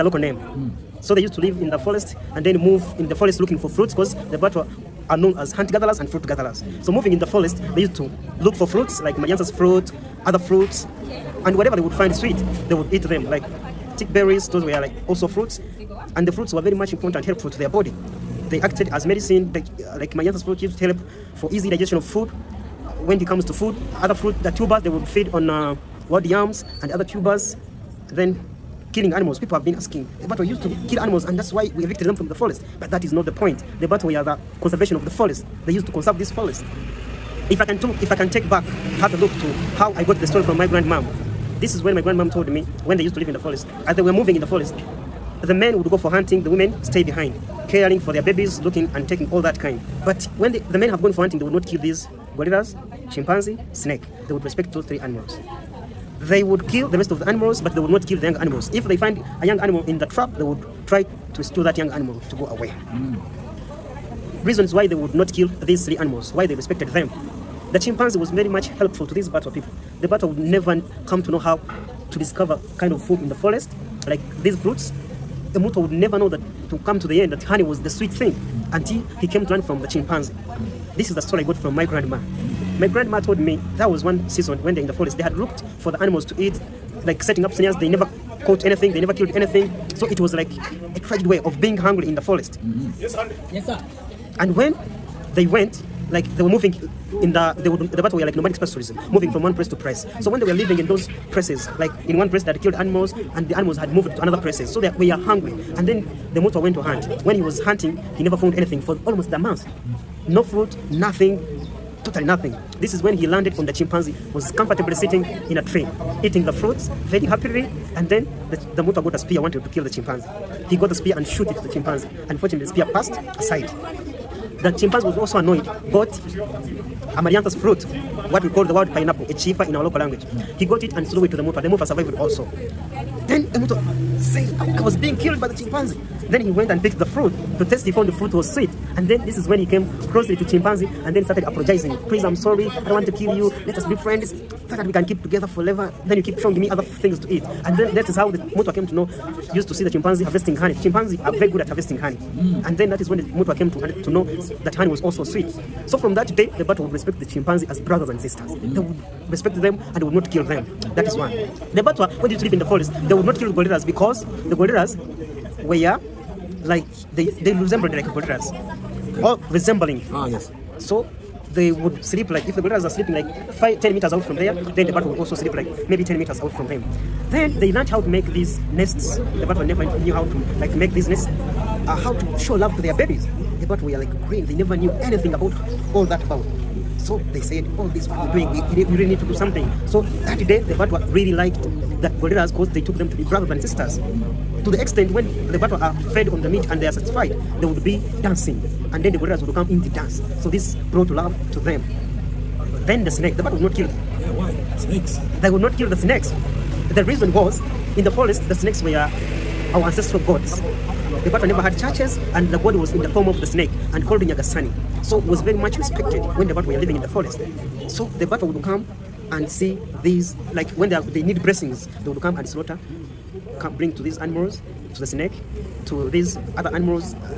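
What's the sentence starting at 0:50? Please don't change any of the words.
But when the, the men have gone for hunting, they would not kill these gorillas, chimpanzee, snake.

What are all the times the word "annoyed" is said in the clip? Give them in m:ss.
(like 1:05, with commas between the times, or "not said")
2:05.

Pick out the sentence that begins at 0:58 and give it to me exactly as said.
If they find a young animal in the trap, they would try to rescue that young animal to go away.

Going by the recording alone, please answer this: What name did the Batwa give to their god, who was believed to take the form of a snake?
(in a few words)
Nyagasani.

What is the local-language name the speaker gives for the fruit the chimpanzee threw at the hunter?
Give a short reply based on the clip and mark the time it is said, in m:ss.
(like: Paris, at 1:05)
chifa, at 2:09.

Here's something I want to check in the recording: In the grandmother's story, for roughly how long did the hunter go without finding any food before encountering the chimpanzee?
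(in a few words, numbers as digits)
almost a month.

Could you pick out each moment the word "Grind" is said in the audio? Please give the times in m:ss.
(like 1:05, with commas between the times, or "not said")
not said.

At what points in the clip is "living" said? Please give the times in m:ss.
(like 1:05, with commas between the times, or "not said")
1:40, 3:36.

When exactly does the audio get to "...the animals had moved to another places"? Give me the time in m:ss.
1:43.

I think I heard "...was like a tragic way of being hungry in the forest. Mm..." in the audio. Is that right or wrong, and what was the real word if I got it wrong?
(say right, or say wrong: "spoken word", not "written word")
right.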